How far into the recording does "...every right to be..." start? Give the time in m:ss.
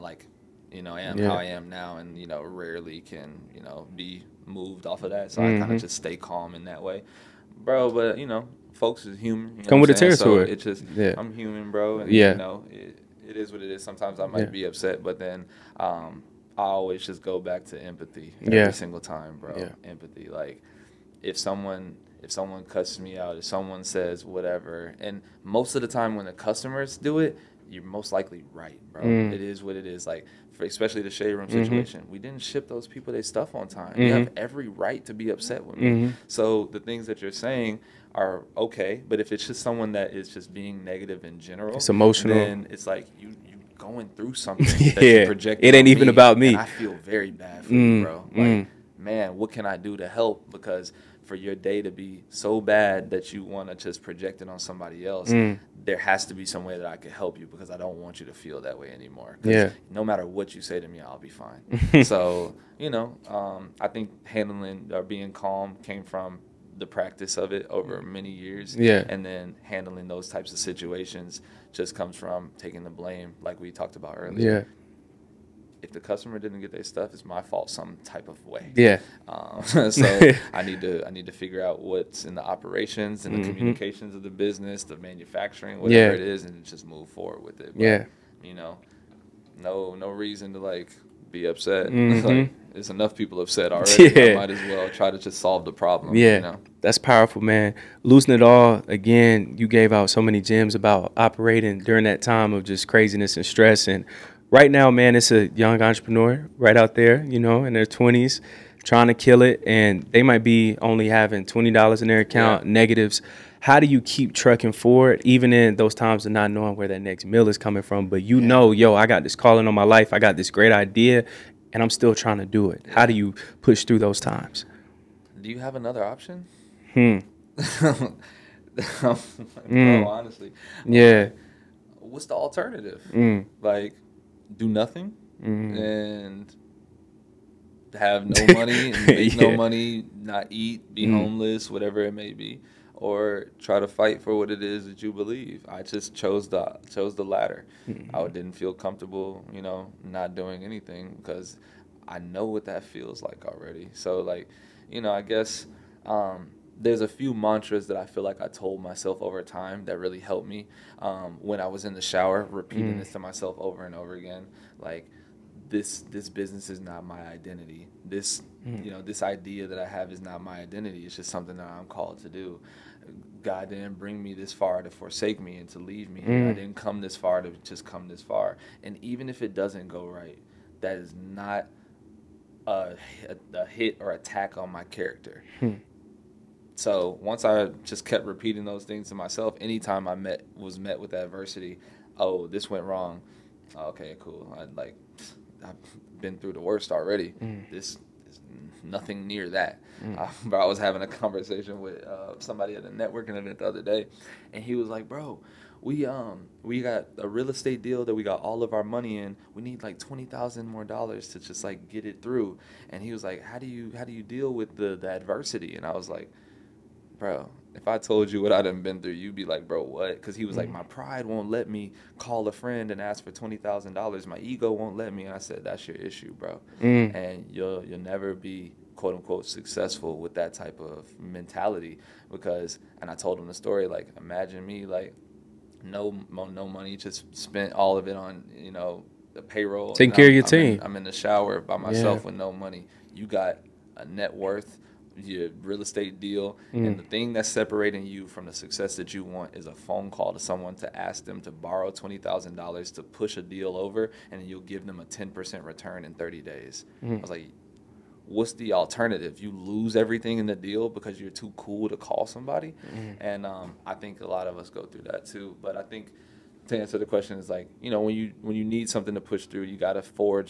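0:34.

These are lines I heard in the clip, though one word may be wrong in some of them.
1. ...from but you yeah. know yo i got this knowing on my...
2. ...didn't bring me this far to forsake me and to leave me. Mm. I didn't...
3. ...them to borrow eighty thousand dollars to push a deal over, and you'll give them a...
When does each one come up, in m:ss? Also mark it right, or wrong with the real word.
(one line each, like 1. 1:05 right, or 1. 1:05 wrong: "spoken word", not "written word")
1. 1:57 wrong: "calling", not "knowing"
2. 2:53 right
3. 4:11 wrong: "twenty", not "eighty".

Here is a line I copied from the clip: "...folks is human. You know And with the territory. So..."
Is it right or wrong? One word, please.
wrong.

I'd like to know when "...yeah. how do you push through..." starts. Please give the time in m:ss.
2:02.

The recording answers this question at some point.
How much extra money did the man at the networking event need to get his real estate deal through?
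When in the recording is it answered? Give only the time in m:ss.
3:29.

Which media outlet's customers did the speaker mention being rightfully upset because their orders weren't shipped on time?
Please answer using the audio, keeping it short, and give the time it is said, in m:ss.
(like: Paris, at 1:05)
The Shade Room, at 0:31.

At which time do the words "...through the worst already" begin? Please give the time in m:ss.
3:16.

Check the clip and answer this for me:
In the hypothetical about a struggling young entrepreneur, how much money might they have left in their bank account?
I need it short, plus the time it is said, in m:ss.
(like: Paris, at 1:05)
$20, at 1:51.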